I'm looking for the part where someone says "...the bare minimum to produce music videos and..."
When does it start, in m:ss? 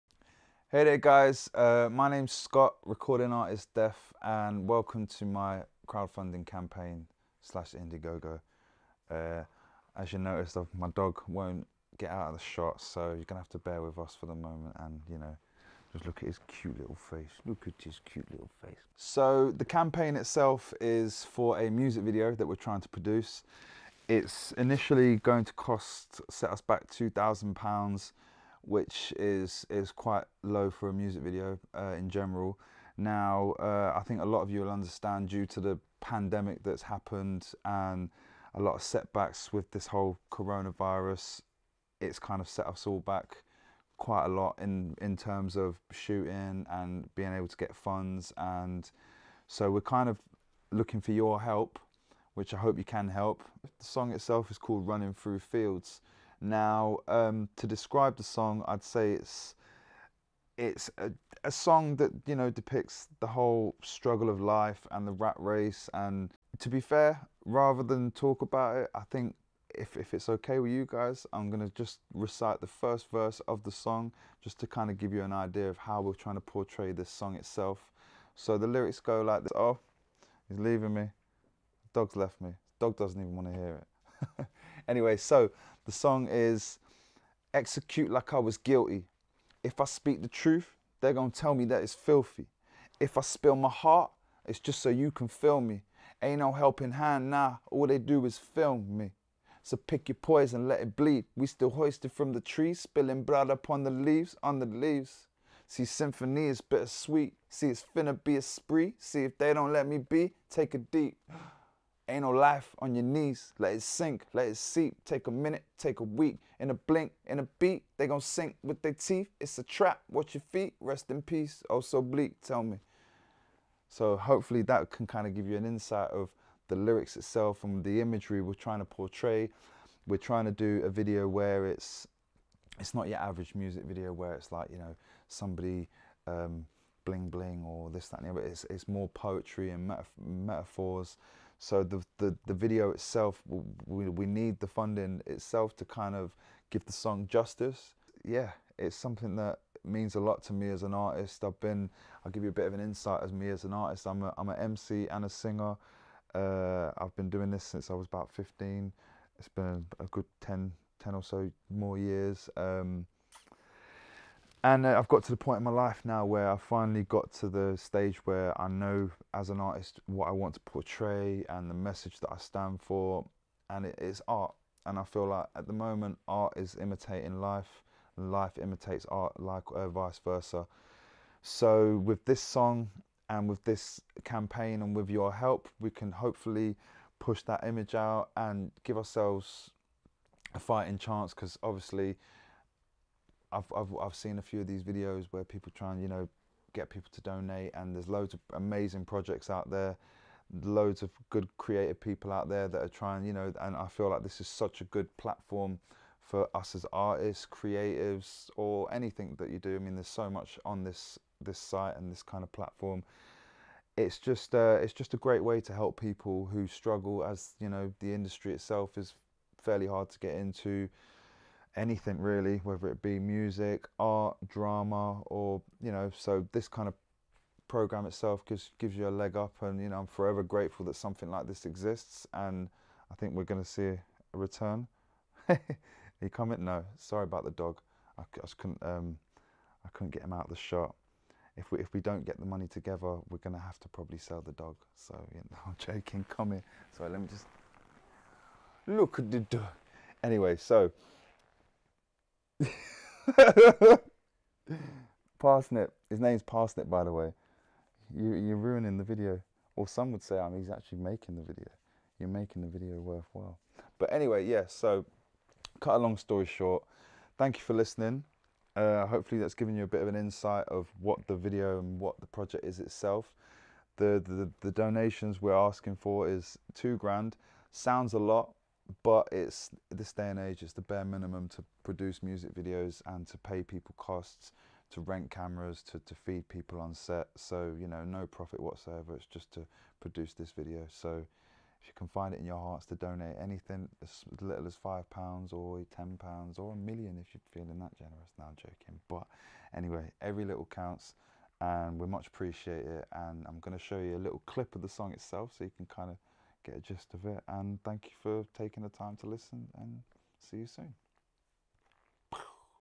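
4:40.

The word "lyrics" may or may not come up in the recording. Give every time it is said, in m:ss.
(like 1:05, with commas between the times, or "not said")
1:18, 2:06.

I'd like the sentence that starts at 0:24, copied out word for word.
It's initially going to cost, set us back £2,000 which is is quite low for a music video uh, in general.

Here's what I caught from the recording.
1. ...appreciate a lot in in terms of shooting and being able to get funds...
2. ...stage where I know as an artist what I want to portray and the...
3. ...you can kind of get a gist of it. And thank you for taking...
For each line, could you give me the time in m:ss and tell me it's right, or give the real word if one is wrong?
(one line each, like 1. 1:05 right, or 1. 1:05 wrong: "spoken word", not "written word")
1. 0:43 wrong: "quite", not "appreciate"
2. 2:47 right
3. 5:05 right.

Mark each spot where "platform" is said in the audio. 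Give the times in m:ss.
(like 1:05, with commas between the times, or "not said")
3:25, 3:32.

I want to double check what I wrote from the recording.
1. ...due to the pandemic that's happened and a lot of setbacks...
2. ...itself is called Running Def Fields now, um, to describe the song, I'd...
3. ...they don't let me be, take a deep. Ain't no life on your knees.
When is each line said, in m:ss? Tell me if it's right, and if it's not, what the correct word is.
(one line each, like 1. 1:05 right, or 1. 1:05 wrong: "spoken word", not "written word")
1. 0:35 right
2. 0:54 wrong: "Through", not "Def"
3. 1:49 right.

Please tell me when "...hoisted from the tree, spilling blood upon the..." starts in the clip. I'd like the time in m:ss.
1:41.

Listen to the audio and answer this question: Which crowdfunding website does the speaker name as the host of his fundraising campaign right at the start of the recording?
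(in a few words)
Indiegogo.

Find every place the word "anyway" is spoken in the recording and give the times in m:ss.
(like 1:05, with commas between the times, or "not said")
1:24, 4:10, 4:24, 4:59.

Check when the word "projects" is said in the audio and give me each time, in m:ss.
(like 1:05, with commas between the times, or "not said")
3:19, 4:32.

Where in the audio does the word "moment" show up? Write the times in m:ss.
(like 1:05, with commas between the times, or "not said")
0:14, 2:55.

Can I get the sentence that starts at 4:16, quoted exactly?
His name's Parsnip, by the way.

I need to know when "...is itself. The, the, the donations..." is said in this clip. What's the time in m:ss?
4:32.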